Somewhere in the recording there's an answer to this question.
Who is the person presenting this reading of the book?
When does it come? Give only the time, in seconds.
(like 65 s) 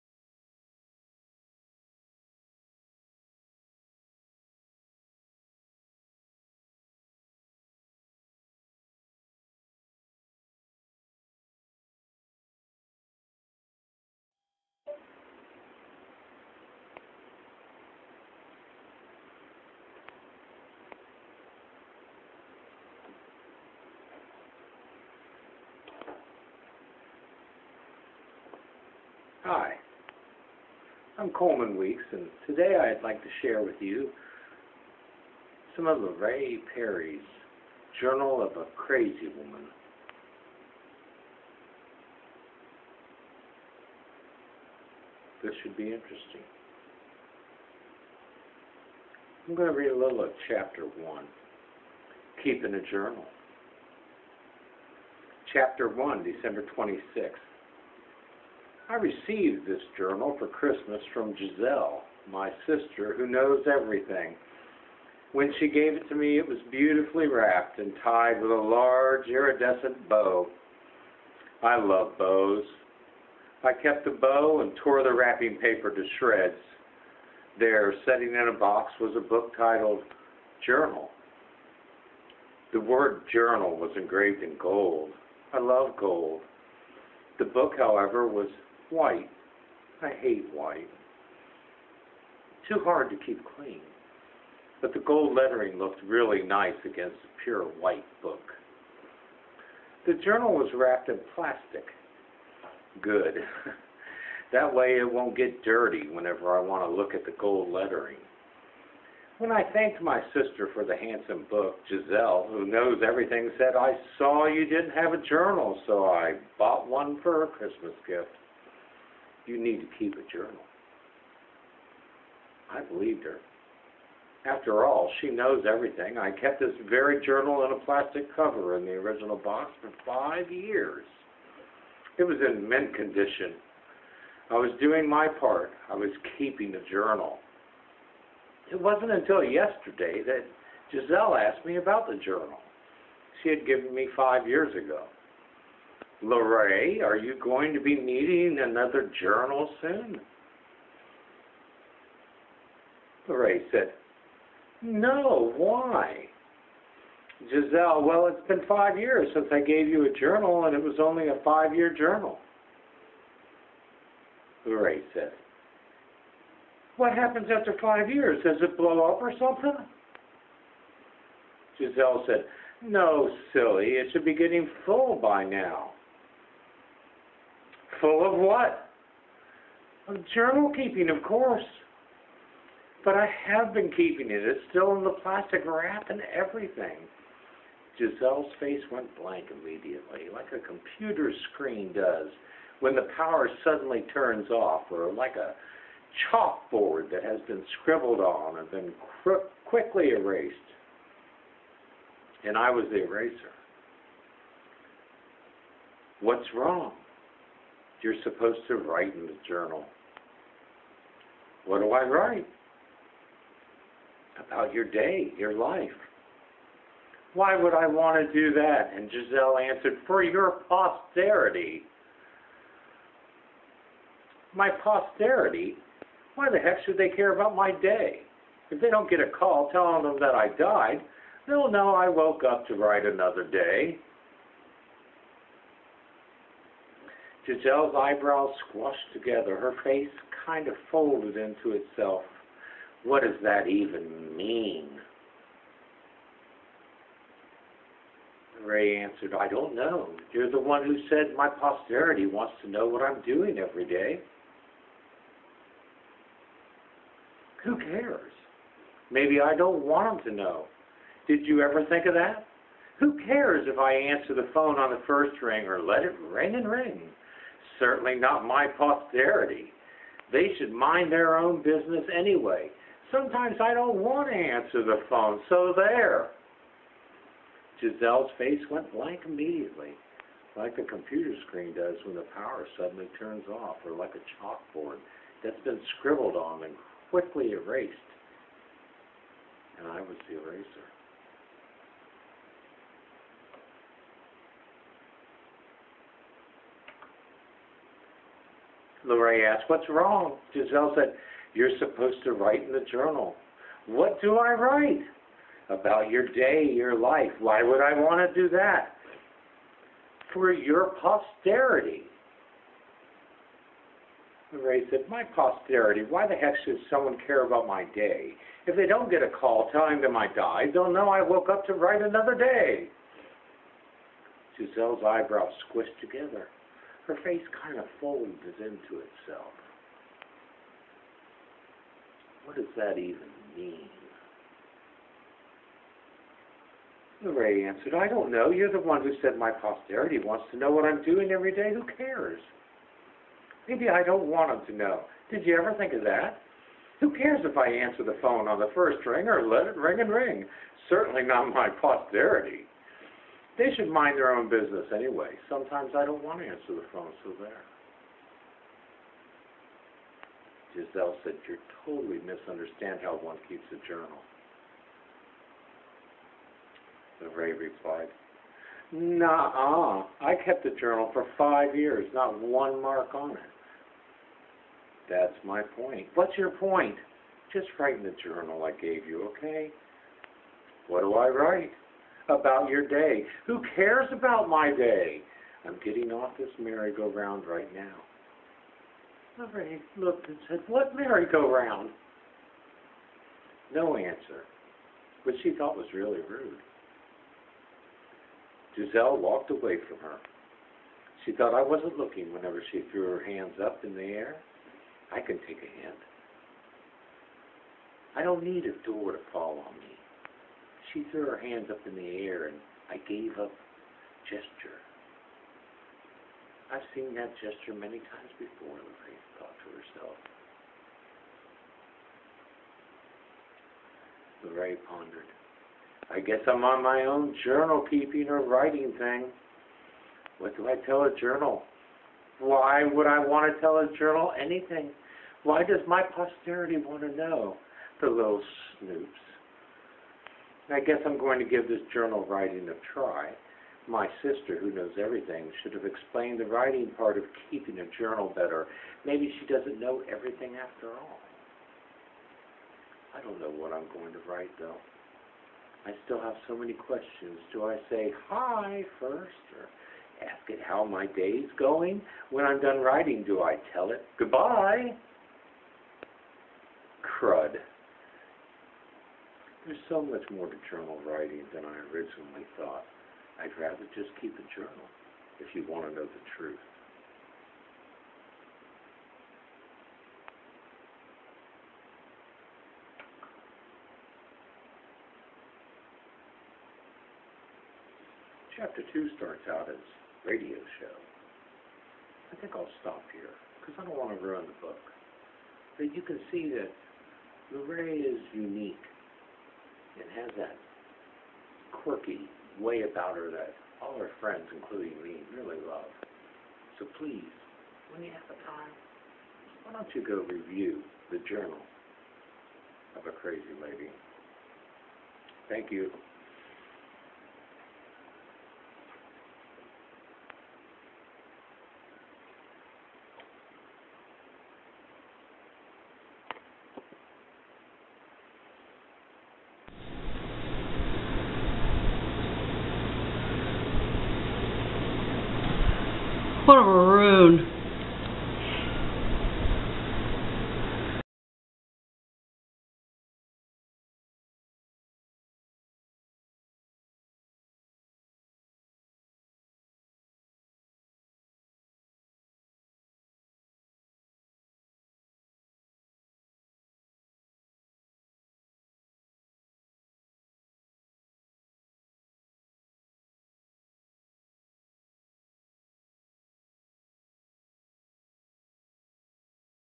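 31 s.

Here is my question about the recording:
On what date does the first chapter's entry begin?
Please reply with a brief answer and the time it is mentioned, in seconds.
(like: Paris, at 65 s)
December 26th, at 56 s.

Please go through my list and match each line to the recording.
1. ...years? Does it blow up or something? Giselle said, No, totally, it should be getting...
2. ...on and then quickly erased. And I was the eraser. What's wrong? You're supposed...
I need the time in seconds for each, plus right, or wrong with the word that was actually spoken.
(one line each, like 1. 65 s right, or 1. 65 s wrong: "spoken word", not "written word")
1. 168 s wrong: "silly", not "totally"
2. 198 s right.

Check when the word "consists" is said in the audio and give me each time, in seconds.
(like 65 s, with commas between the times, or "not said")
not said.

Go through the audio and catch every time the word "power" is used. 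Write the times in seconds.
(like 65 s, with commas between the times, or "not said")
193 s, 282 s.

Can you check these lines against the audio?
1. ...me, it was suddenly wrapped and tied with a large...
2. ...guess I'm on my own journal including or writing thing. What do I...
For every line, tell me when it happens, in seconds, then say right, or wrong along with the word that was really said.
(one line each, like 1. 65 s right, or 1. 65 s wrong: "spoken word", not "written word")
1. 66 s wrong: "beautifully", not "suddenly"
2. 426 s wrong: "keeping", not "including".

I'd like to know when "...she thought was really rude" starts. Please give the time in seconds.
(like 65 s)
395 s.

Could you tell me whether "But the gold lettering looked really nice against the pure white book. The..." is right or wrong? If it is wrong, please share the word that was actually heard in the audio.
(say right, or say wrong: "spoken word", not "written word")
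right.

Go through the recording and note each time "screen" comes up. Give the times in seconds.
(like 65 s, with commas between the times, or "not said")
191 s, 281 s.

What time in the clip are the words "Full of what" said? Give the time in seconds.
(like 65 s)
178 s.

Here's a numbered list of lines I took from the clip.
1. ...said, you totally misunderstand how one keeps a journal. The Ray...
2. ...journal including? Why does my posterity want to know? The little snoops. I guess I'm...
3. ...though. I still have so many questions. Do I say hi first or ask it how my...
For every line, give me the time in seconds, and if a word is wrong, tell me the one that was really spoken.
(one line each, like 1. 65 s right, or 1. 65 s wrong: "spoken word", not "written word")
1. 361 s right
2. 433 s wrong: "anything", not "including"
3. 454 s right.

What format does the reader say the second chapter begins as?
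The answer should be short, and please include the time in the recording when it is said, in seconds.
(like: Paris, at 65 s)
Radio show, at 490 s.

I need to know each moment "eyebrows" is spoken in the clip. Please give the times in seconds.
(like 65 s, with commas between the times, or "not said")
237 s, 325 s.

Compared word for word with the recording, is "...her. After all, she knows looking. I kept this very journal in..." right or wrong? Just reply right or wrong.
wrong.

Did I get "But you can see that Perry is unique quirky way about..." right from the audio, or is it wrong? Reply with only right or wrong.
wrong.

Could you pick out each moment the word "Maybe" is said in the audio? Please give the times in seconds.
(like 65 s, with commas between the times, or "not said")
259 s, 343 s, 449 s.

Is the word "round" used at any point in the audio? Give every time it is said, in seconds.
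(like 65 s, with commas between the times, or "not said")
386 s, 390 s.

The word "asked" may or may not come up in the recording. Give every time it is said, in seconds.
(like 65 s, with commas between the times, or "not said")
141 s, 299 s.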